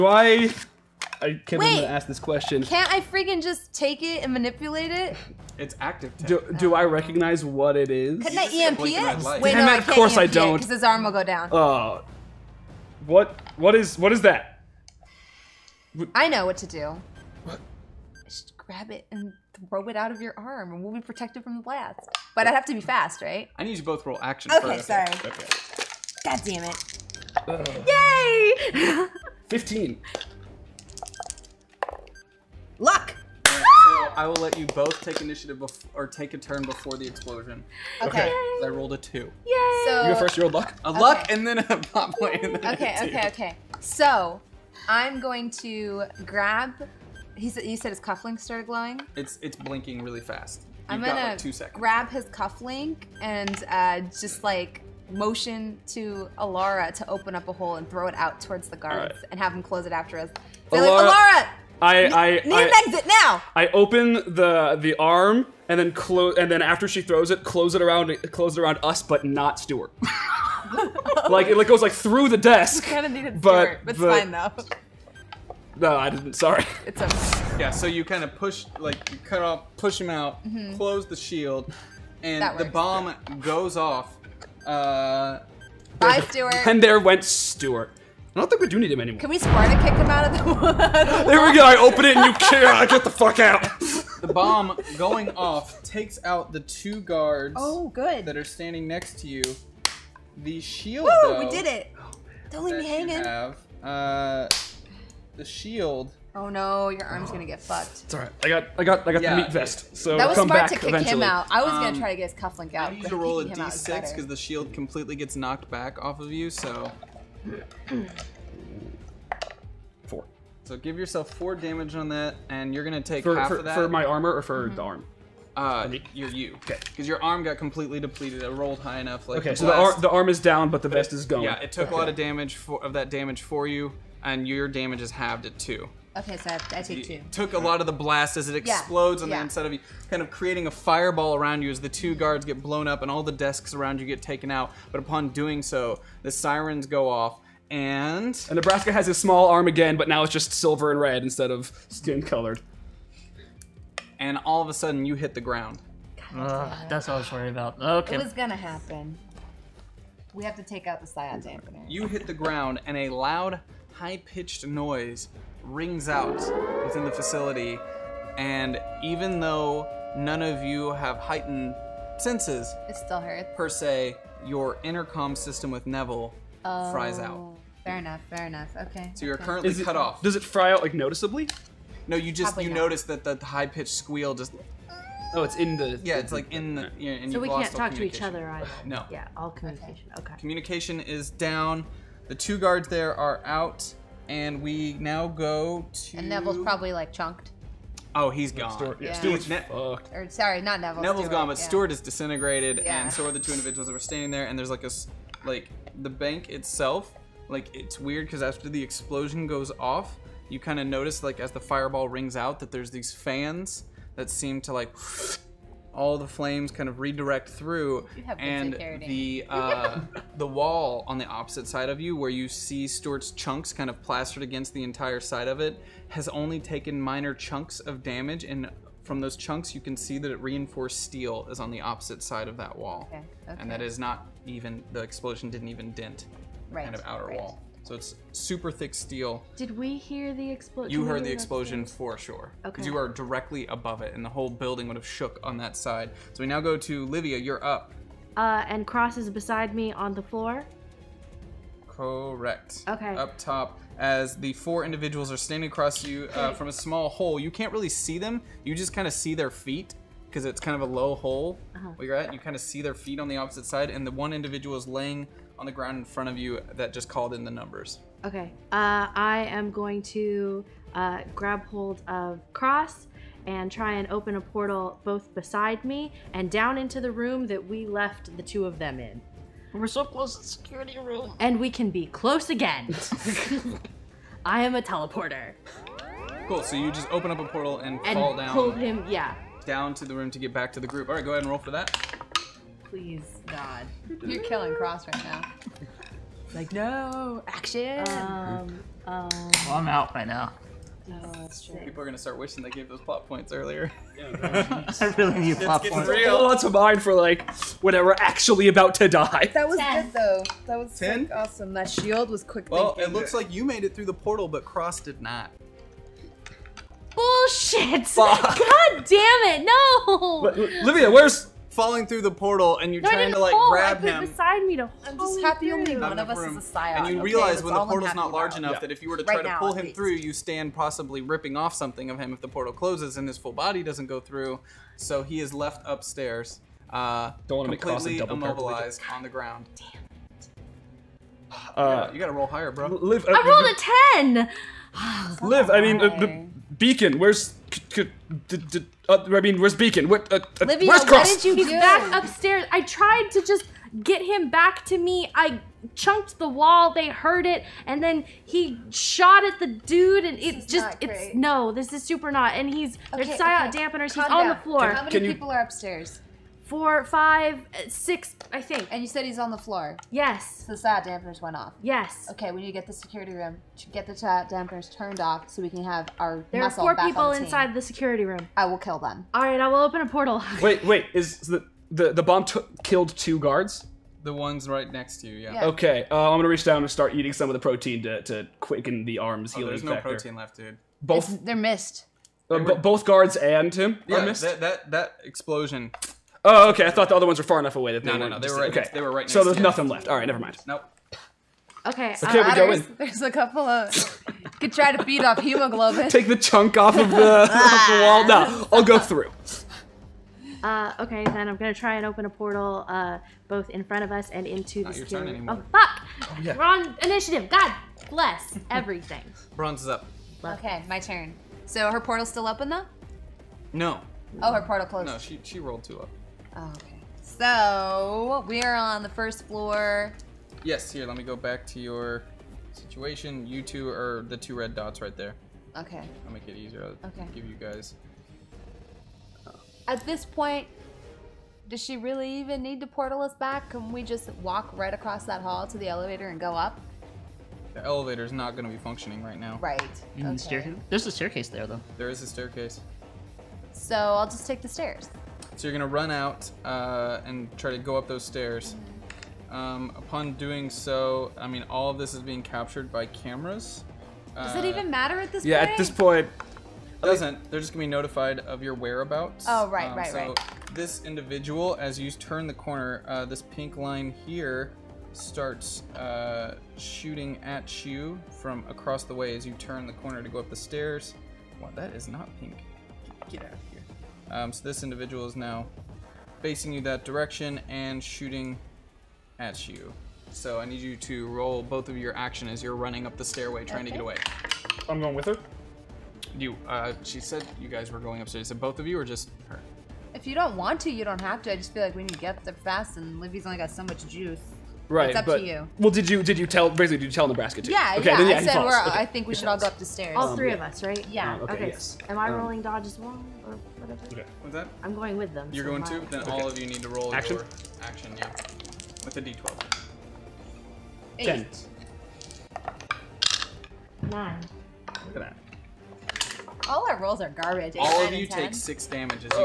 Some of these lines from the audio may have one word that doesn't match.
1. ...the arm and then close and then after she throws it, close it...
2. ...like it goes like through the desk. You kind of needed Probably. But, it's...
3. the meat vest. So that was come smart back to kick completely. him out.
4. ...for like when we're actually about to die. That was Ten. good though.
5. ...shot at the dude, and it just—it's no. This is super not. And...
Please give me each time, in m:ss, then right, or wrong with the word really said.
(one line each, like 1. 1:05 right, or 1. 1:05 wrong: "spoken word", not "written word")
1. 1:04 right
2. 1:11 wrong: "Stuart", not "Probably"
3. 1:49 wrong: "eventually", not "completely"
4. 5:07 right
5. 5:58 right.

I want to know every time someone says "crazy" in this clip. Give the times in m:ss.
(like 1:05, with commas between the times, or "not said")
not said.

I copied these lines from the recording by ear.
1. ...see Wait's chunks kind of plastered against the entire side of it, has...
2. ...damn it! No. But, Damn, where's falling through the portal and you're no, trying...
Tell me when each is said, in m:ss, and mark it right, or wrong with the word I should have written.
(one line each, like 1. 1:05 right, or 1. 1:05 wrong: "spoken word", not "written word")
1. 3:42 wrong: "Stuart", not "Wait"
2. 5:19 wrong: "Livia", not "Damn".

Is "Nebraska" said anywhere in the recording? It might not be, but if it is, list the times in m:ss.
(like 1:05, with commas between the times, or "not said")
2:28, 8:27.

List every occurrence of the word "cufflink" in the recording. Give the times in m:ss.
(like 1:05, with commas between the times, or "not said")
0:47, 0:52, 1:52.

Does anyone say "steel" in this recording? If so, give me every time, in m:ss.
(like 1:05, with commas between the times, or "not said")
3:51, 3:58.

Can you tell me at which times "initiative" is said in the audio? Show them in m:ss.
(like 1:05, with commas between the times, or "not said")
0:35, 6:57.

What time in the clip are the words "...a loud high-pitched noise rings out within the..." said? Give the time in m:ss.
2:42.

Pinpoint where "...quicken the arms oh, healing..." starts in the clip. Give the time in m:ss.
6:28.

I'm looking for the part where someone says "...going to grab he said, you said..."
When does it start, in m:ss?
0:45.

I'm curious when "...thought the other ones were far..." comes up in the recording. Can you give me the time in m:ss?
6:36.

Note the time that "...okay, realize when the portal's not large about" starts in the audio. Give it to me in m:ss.
5:27.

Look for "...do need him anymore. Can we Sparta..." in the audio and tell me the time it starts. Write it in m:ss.
1:28.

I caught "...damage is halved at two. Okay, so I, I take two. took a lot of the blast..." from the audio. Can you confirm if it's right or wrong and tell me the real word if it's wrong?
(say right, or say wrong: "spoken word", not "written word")
right.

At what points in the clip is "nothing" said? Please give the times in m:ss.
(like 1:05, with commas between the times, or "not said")
6:39.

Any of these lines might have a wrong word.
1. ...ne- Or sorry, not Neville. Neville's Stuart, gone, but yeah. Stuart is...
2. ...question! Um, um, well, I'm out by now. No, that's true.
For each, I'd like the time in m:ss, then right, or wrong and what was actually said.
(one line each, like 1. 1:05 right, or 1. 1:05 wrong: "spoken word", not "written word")
1. 3:19 right
2. 4:57 wrong: "action", not "question".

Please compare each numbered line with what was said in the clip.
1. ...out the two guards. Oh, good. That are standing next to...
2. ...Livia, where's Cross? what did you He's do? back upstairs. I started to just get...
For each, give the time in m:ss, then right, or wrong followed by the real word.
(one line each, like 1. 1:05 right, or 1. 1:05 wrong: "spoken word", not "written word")
1. 1:36 right
2. 5:50 wrong: "tried", not "started".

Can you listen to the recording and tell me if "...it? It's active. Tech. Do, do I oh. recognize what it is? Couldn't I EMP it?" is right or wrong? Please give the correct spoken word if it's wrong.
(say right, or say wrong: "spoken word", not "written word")
right.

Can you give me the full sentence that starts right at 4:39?
We're so close to the security room.